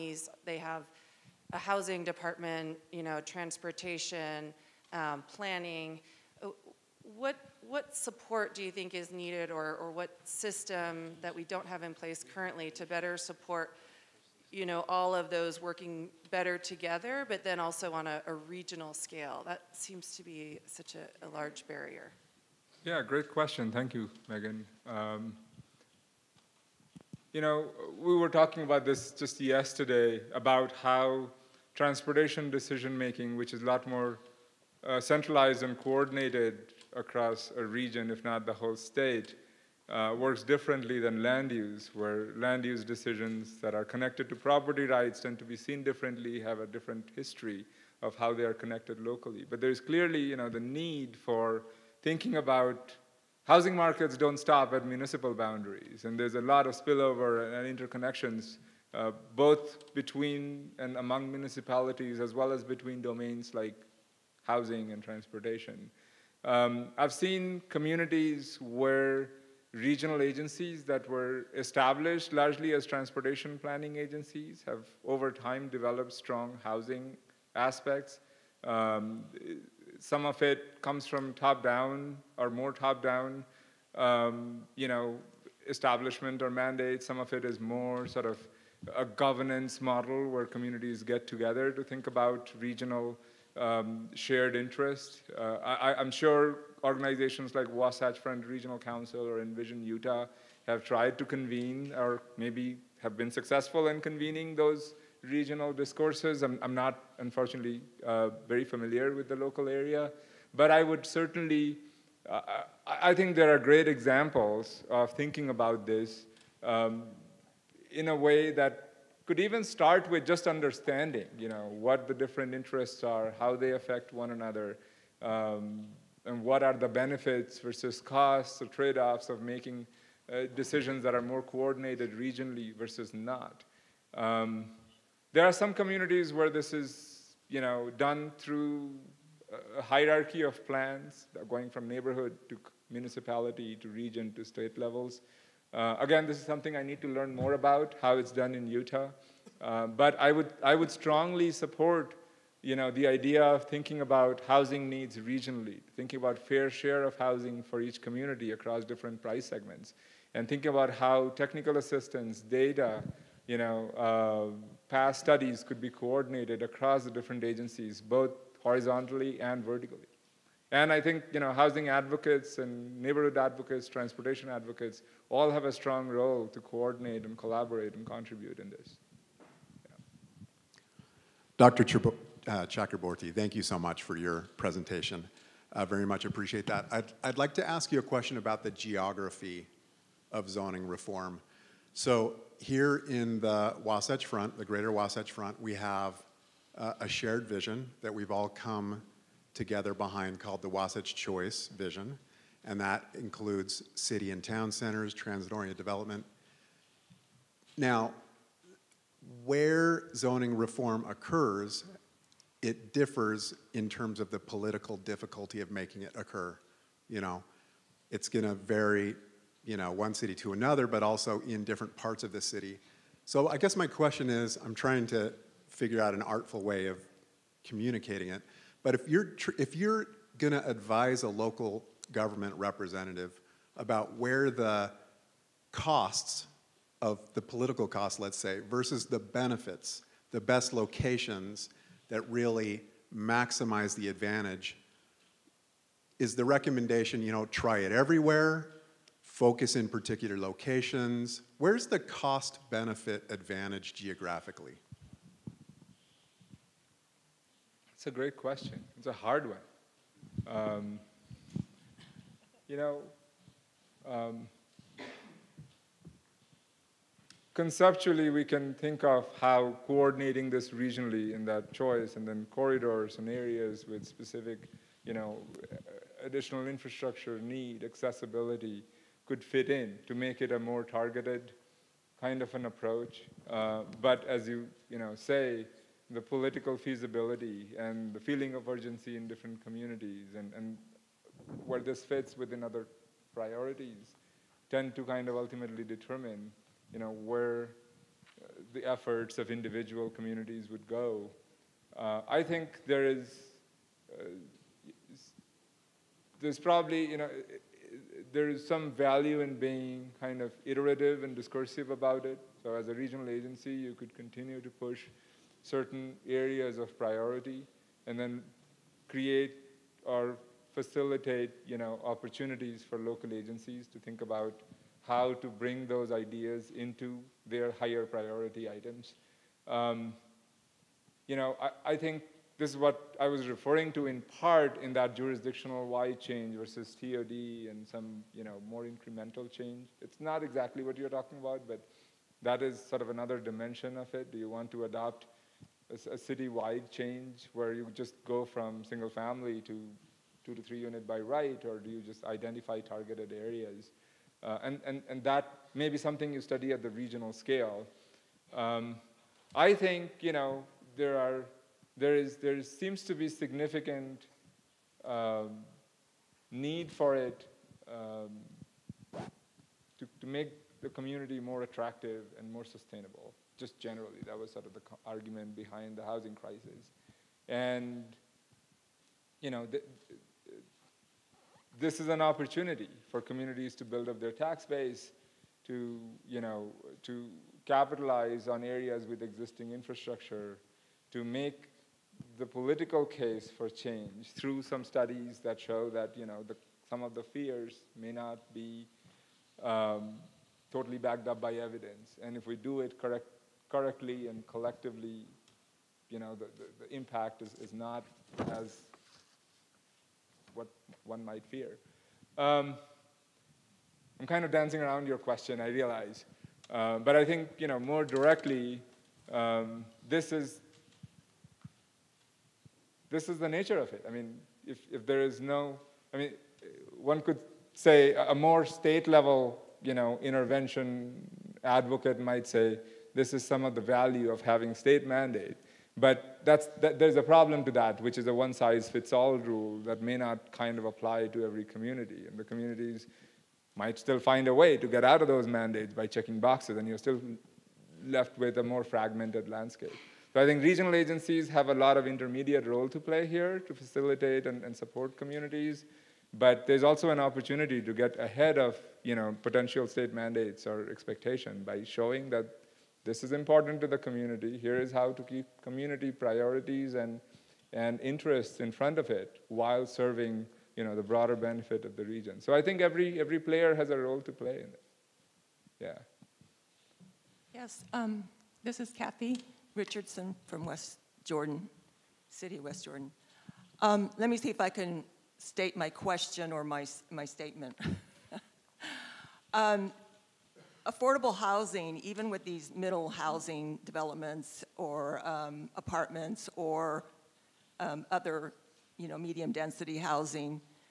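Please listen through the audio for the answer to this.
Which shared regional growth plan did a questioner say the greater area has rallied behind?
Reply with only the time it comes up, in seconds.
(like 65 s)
200 s.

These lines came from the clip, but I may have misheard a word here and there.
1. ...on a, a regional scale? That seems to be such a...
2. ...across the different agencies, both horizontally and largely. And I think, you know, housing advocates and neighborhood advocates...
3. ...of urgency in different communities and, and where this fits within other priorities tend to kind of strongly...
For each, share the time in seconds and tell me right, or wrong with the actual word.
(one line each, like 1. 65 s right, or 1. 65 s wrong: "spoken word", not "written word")
1. 17 s right
2. 166 s wrong: "vertically", not "largely"
3. 288 s wrong: "ultimately", not "strongly".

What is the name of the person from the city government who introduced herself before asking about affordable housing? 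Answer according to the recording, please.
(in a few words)
Kathy Richardson.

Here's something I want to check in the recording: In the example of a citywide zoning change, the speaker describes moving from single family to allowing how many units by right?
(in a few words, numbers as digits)
2 to 3.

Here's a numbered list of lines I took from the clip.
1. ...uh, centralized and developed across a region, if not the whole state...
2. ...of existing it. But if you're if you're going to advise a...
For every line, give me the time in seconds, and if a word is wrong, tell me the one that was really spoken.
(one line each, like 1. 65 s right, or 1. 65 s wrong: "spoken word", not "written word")
1. 34 s wrong: "coordinated", not "developed"
2. 226 s wrong: "communicating", not "existing".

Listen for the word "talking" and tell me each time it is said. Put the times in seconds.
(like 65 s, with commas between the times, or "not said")
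28 s, 341 s.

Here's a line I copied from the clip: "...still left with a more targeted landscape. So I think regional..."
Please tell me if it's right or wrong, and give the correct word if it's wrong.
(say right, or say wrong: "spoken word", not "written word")
wrong: "fragmented", not "targeted".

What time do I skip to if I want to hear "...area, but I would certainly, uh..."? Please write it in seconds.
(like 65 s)
109 s.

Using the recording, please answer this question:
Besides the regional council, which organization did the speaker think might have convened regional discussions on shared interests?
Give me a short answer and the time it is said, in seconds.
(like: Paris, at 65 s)
Envision Utah, at 99 s.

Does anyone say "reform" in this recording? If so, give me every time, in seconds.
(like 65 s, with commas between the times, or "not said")
190 s, 210 s.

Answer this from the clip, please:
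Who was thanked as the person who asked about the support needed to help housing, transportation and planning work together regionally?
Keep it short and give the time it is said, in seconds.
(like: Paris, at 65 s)
Megan, at 24 s.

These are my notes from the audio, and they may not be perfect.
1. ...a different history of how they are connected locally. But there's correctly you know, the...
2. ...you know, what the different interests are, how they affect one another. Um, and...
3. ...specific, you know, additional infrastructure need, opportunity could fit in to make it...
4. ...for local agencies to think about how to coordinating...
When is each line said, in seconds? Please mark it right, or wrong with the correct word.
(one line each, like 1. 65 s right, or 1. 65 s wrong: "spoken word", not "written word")
1. 46 s wrong: "clearly", not "correctly"
2. 121 s right
3. 274 s wrong: "accessibility", not "opportunity"
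4. 322 s wrong: "bring", not "coordinating".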